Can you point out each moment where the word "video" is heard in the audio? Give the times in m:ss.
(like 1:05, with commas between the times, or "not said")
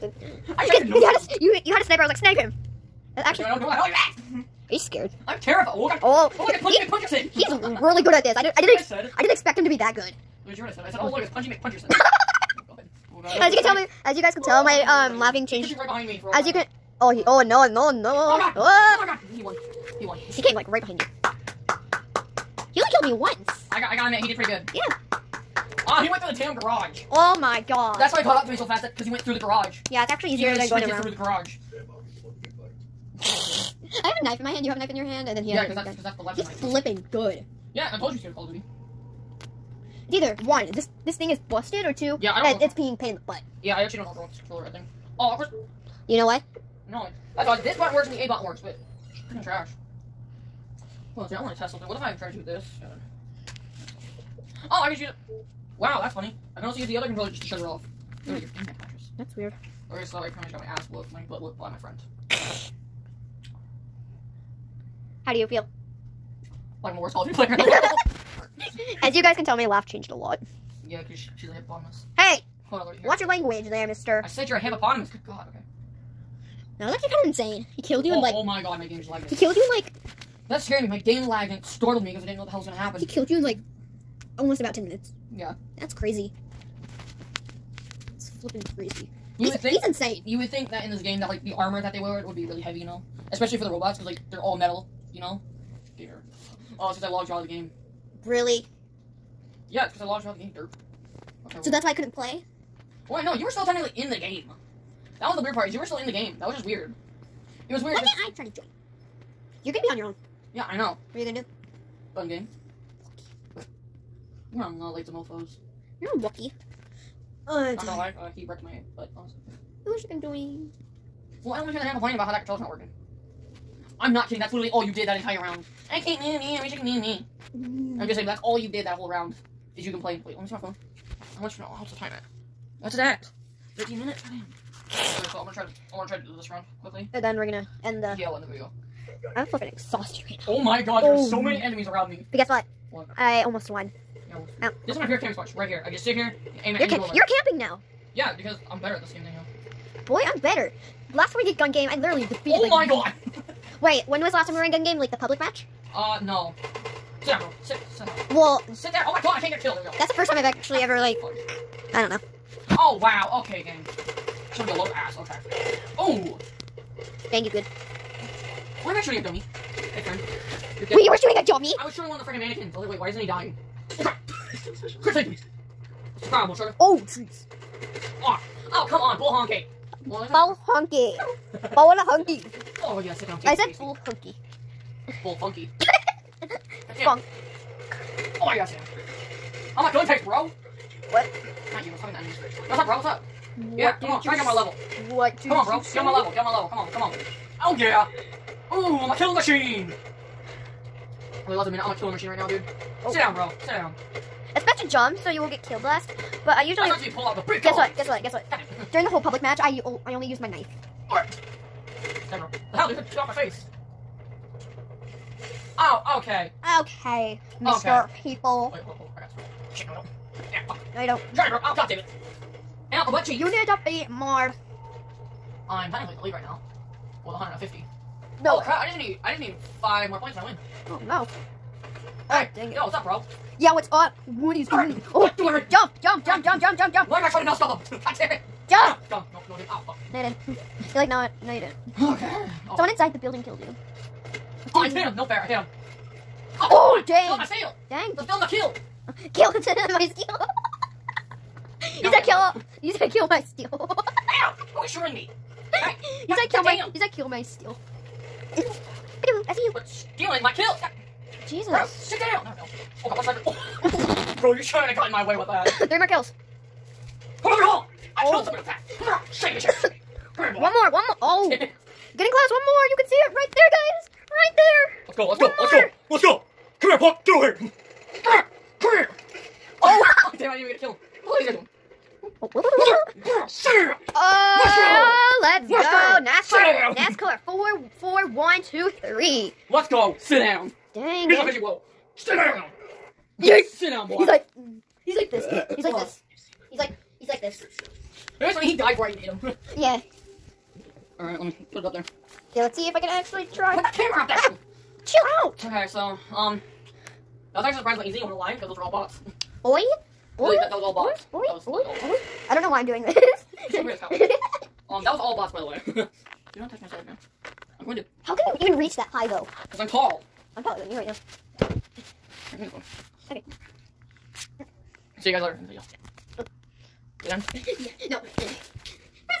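2:18, 5:25.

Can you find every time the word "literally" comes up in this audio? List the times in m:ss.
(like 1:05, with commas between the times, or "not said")
2:04, 2:31.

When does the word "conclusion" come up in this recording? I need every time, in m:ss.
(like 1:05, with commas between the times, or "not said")
not said.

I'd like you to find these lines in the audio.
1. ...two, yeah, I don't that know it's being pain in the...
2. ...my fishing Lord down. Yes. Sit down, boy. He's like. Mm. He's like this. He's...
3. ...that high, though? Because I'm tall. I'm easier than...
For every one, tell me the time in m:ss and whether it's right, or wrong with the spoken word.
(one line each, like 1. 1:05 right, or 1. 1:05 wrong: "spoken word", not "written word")
1. 0:41 right
2. 4:51 wrong: "Sit", not "Lord"
3. 5:18 wrong: "taller", not "easier".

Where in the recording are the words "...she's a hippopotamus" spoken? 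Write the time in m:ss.
1:11.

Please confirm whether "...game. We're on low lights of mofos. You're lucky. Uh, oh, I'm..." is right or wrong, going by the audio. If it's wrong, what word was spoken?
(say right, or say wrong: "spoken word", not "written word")
right.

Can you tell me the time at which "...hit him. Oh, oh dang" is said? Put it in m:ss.
4:05.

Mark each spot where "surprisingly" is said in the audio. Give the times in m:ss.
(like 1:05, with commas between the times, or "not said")
5:07.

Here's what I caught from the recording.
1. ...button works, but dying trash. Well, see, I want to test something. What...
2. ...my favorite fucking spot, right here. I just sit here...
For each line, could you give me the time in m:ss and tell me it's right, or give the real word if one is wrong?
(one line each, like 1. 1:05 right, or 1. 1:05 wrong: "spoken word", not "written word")
1. 0:48 wrong: "freaking", not "dying"
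2. 2:24 wrong: "camping", not "fucking".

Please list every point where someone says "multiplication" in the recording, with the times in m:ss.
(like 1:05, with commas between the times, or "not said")
not said.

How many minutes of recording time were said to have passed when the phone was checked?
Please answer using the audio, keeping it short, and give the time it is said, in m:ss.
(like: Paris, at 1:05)
13 minutes, at 2:13.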